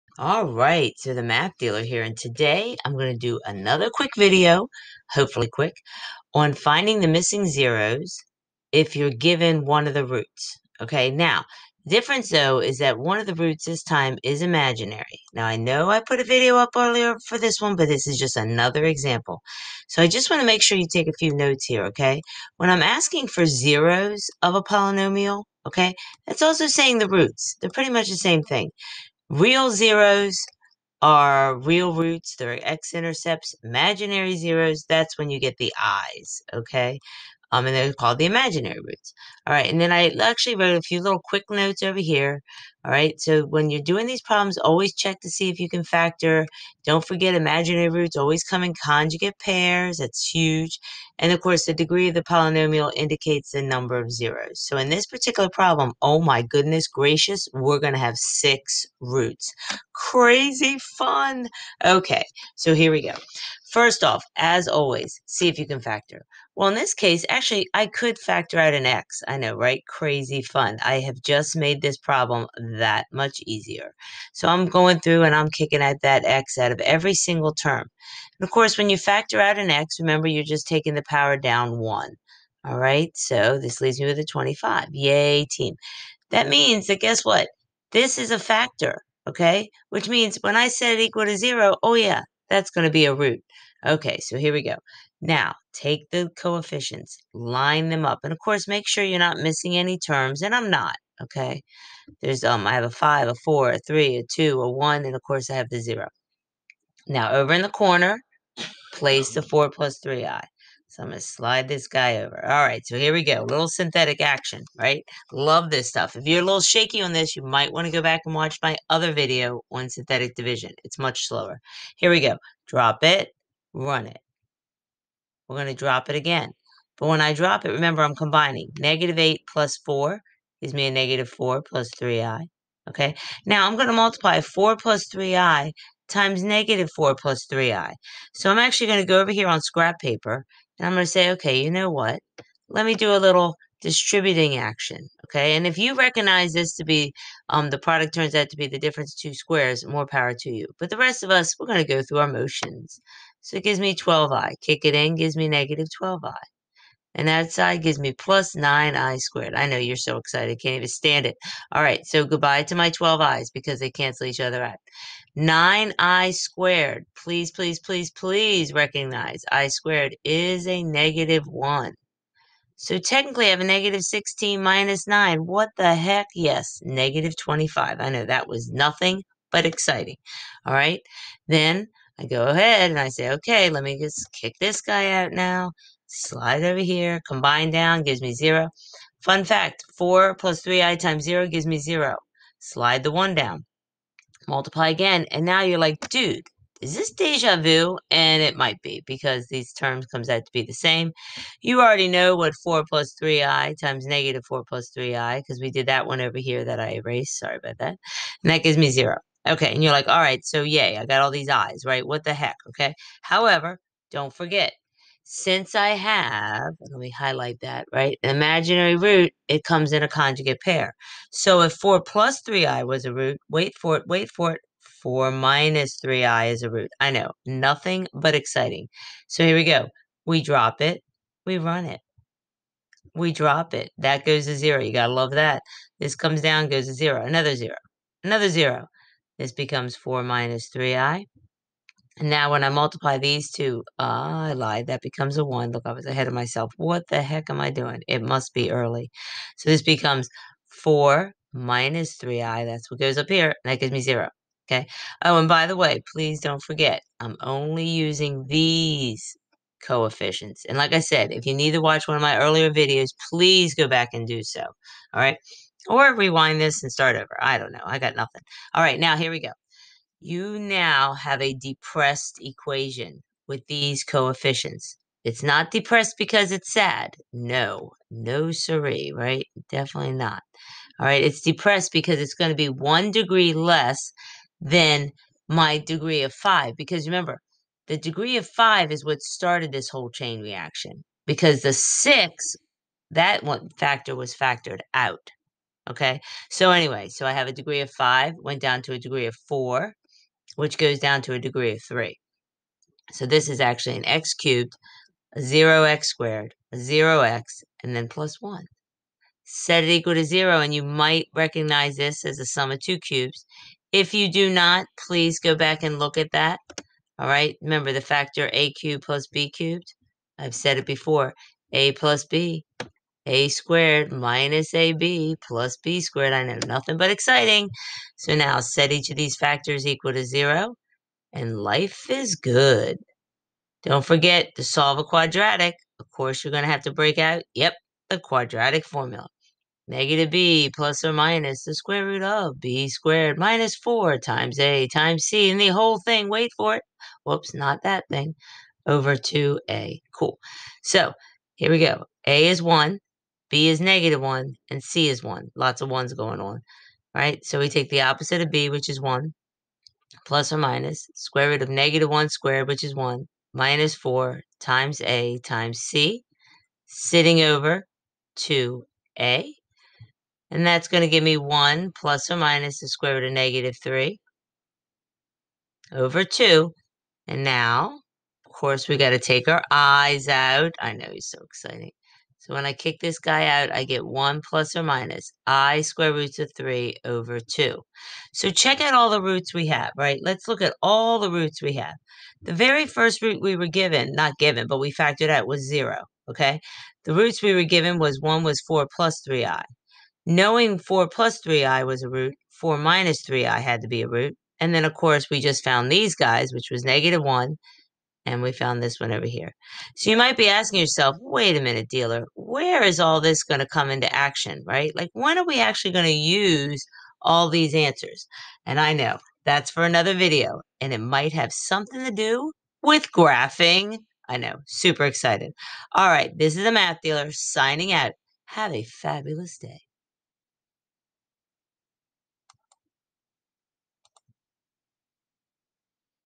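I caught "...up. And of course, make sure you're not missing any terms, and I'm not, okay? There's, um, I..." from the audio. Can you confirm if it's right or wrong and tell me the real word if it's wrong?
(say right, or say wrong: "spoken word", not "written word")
right.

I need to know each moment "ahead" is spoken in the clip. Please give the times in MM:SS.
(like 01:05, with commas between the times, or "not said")
03:02, 04:06.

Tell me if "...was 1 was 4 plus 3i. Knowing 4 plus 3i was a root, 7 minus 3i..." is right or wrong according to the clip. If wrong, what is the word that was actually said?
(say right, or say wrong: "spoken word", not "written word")
wrong: "4", not "7".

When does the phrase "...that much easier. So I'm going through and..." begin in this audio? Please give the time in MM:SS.
01:12.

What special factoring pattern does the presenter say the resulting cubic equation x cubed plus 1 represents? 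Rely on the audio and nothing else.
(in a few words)
sum of two cubes.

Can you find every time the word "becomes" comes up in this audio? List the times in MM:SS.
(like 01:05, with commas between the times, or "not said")
03:59, 04:05, 04:09.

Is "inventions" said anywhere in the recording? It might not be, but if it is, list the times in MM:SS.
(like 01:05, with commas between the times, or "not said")
not said.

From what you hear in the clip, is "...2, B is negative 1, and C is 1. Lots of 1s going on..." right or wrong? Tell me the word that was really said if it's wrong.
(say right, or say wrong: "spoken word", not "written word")
wrong: "1", not "2".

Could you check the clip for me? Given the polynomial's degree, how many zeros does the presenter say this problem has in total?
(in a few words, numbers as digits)
6.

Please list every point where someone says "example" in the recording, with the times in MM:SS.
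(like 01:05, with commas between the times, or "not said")
00:18.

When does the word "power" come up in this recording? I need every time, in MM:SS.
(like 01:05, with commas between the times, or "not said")
01:21, 02:30.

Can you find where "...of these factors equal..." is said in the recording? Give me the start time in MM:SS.
05:29.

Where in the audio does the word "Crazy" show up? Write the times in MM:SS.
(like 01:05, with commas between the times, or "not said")
00:59, 01:09.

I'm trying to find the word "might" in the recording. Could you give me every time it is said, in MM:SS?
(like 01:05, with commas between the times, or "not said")
01:57, 03:18, 05:10, 06:50, 07:00.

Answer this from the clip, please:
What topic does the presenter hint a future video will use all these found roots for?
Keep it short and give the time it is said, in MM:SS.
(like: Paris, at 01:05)
graphing, at 07:03.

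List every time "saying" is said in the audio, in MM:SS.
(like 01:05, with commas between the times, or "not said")
00:26.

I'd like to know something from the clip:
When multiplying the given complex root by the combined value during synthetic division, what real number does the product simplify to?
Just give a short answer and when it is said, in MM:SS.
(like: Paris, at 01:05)
-25, at 02:56.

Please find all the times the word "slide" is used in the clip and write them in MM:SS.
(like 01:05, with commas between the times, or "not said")
01:51, 03:06, 03:12.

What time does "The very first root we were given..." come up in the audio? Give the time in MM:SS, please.
06:32.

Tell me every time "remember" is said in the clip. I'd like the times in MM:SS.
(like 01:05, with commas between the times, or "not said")
01:20, 02:07, 04:47, 05:17.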